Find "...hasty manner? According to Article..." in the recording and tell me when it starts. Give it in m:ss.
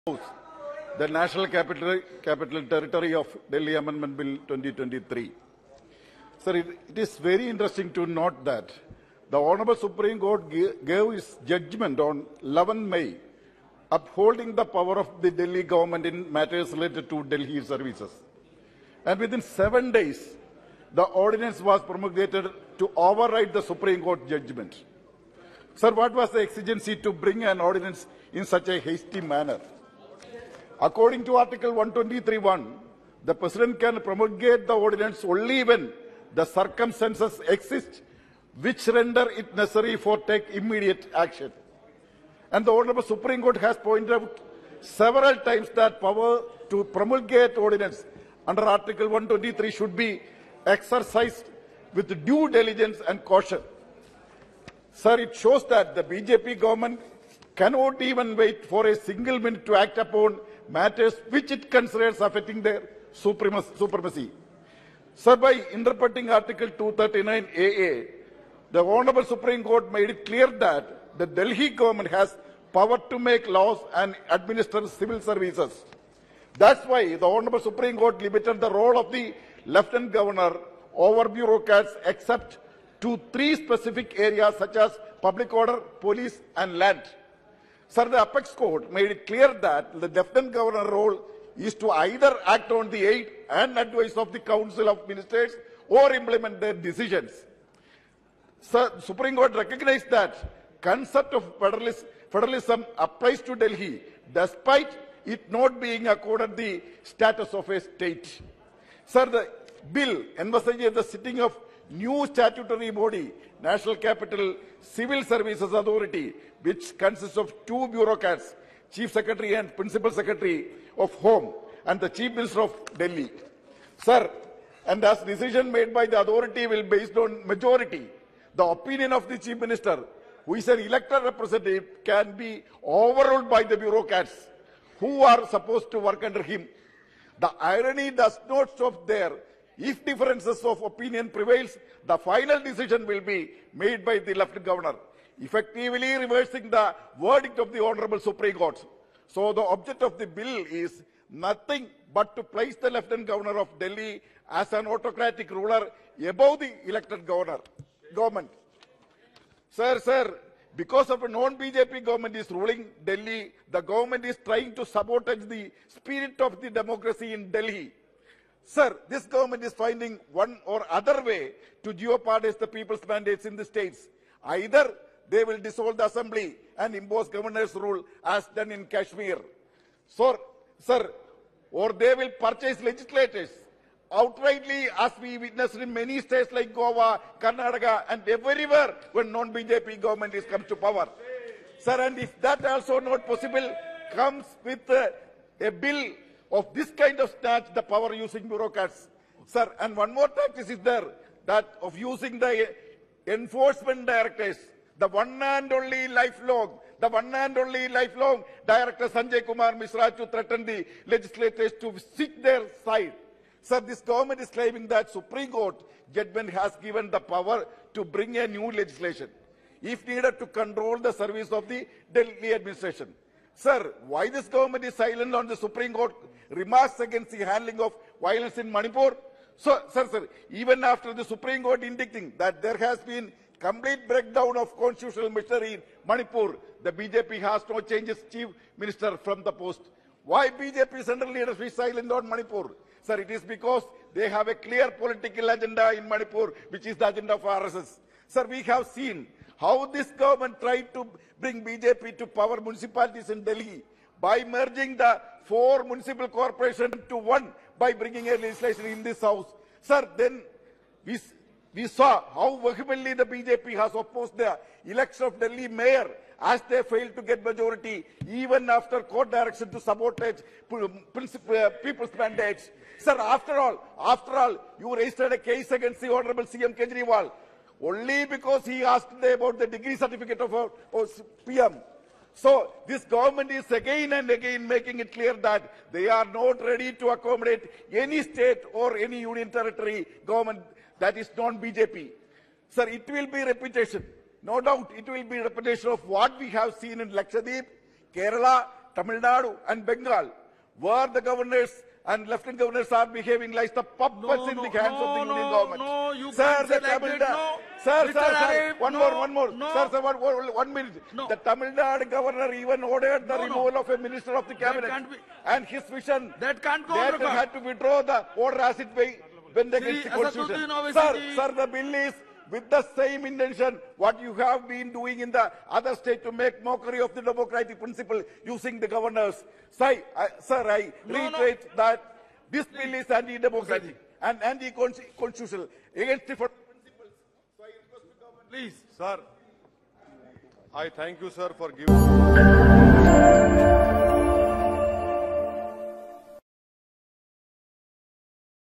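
0:28.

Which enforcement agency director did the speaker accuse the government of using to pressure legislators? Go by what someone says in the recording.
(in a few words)
Sanjay Kumar Mishra.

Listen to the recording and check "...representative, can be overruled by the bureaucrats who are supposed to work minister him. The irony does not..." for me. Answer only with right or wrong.
wrong.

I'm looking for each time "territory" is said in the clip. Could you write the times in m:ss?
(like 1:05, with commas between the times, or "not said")
0:02, 4:49.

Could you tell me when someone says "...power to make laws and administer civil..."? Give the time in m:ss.
1:12.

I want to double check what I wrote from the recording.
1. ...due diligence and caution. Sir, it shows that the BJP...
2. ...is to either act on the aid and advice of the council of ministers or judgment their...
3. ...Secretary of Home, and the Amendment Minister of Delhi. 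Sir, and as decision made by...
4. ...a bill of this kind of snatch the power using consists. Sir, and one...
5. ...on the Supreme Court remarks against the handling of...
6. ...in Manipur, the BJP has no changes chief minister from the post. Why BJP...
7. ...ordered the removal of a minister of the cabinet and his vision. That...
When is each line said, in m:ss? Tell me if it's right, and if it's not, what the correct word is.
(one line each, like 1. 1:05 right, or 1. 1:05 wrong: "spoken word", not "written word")
1. 0:52 right
2. 1:31 wrong: "implement", not "judgment"
3. 2:00 wrong: "Chief", not "Amendment"
4. 3:15 wrong: "bureaucrats", not "consists"
5. 3:45 right
6. 3:55 right
7. 5:12 right.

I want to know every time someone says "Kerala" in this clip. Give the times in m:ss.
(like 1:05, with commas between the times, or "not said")
4:58.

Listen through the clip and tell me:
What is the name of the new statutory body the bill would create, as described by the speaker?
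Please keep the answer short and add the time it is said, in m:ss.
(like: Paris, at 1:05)
National Capital Civil Services Authority, at 1:53.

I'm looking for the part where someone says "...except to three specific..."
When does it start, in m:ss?
1:22.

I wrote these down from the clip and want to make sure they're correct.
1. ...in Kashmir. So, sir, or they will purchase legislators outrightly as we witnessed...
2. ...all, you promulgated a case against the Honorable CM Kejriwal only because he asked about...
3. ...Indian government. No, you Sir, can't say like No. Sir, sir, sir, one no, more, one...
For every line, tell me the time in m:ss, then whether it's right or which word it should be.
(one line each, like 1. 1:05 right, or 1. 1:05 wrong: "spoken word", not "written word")
1. 2:58 right
2. 4:34 wrong: "registered", not "promulgated"
3. 5:05 right.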